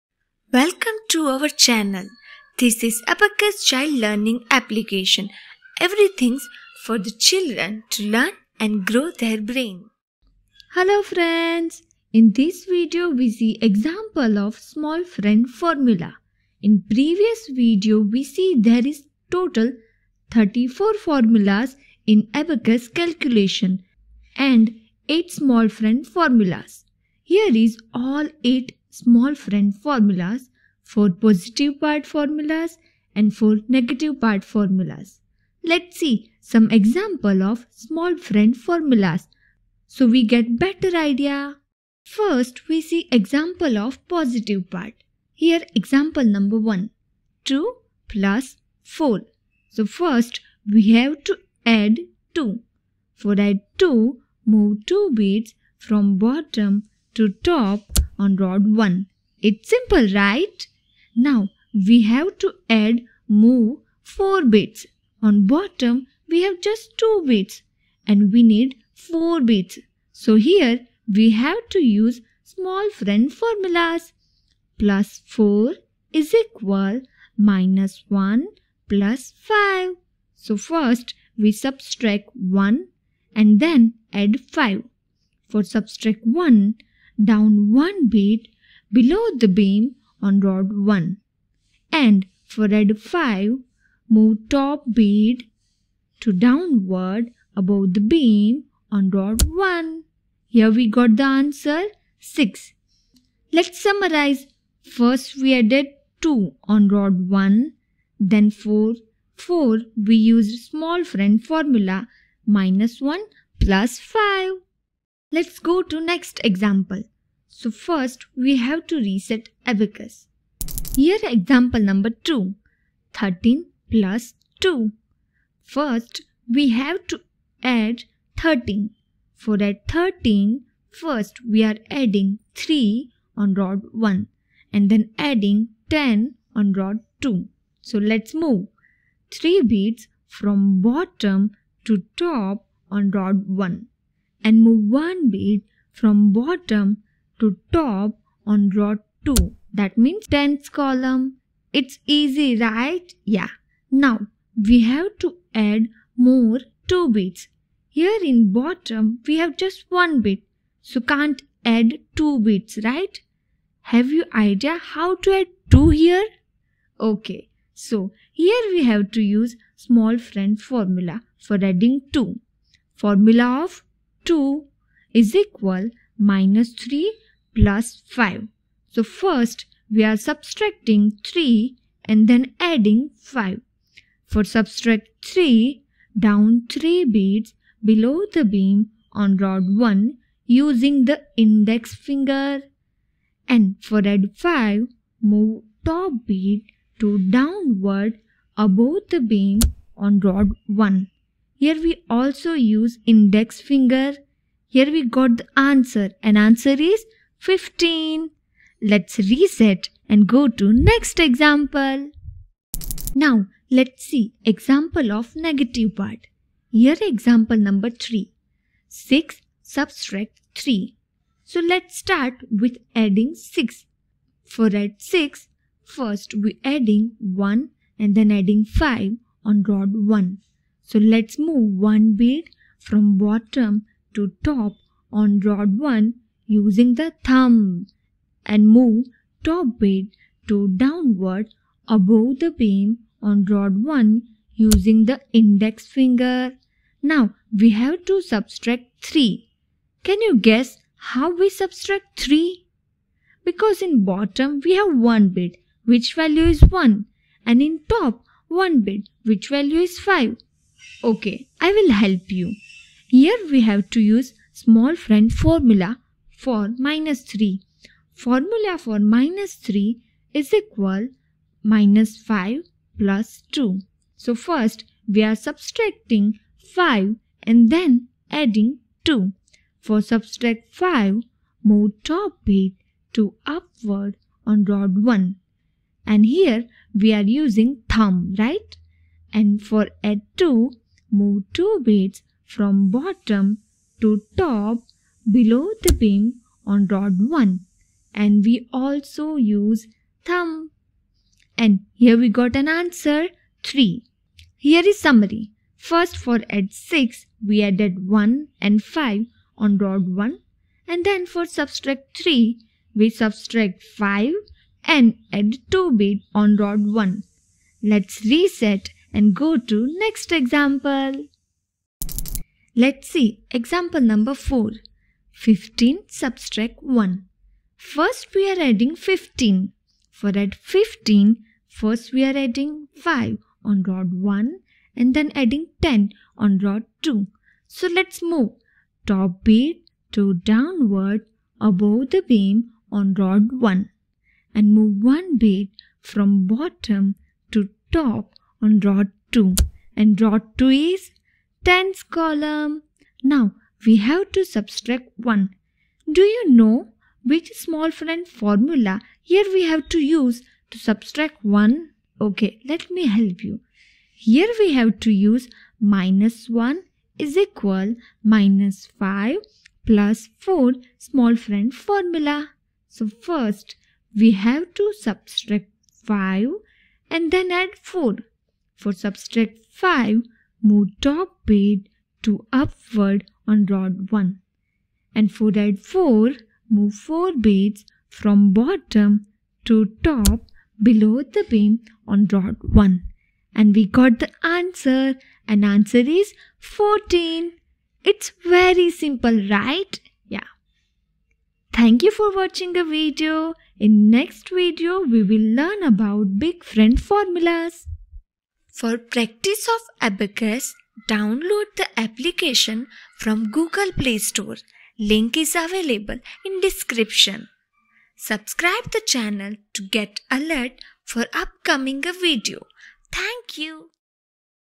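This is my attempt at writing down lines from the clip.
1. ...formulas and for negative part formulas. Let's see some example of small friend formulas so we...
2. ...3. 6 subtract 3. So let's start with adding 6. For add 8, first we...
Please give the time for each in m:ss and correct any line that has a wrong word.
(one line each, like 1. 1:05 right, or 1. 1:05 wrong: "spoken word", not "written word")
1. 0:32 right
2. 3:37 wrong: "6", not "8".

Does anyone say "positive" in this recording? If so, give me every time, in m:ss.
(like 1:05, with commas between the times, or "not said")
0:31, 0:44.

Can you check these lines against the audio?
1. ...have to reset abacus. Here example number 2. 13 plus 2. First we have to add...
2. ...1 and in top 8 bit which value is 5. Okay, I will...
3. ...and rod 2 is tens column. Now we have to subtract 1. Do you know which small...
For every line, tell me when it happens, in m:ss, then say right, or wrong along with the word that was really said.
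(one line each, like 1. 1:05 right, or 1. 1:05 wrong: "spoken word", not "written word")
1. 1:58 right
2. 4:16 wrong: "1", not "8"
3. 5:50 right.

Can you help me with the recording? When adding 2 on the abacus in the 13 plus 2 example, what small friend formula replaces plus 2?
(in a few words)
minus 3 plus 5.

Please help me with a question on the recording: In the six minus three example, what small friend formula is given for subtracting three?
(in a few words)
minus 5 plus 2.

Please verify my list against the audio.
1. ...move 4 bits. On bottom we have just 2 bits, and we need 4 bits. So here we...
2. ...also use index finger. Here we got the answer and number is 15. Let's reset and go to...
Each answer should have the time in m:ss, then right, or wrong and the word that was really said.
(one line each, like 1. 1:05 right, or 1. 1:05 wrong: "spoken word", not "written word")
1. 1:03 right
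2. 3:22 wrong: "answer", not "number".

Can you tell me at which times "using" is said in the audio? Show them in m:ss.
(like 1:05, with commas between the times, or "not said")
3:10, 3:56, 4:04, 4:47.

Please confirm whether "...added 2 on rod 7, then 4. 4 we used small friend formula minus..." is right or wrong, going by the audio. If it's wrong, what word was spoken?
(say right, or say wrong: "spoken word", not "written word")
wrong: "1", not "7".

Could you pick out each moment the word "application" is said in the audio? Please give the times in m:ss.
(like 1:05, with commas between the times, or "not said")
0:04, 6:51.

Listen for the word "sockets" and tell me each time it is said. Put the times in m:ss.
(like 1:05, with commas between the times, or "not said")
not said.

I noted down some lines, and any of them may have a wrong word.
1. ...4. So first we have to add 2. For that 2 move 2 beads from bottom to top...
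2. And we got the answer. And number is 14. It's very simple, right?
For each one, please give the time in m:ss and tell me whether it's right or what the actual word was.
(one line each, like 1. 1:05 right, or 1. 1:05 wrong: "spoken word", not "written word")
1. 0:48 right
2. 6:33 wrong: "answer", not "number".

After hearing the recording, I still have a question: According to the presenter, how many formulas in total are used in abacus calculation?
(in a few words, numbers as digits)
34.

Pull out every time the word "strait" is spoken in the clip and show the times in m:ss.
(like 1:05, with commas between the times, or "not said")
not said.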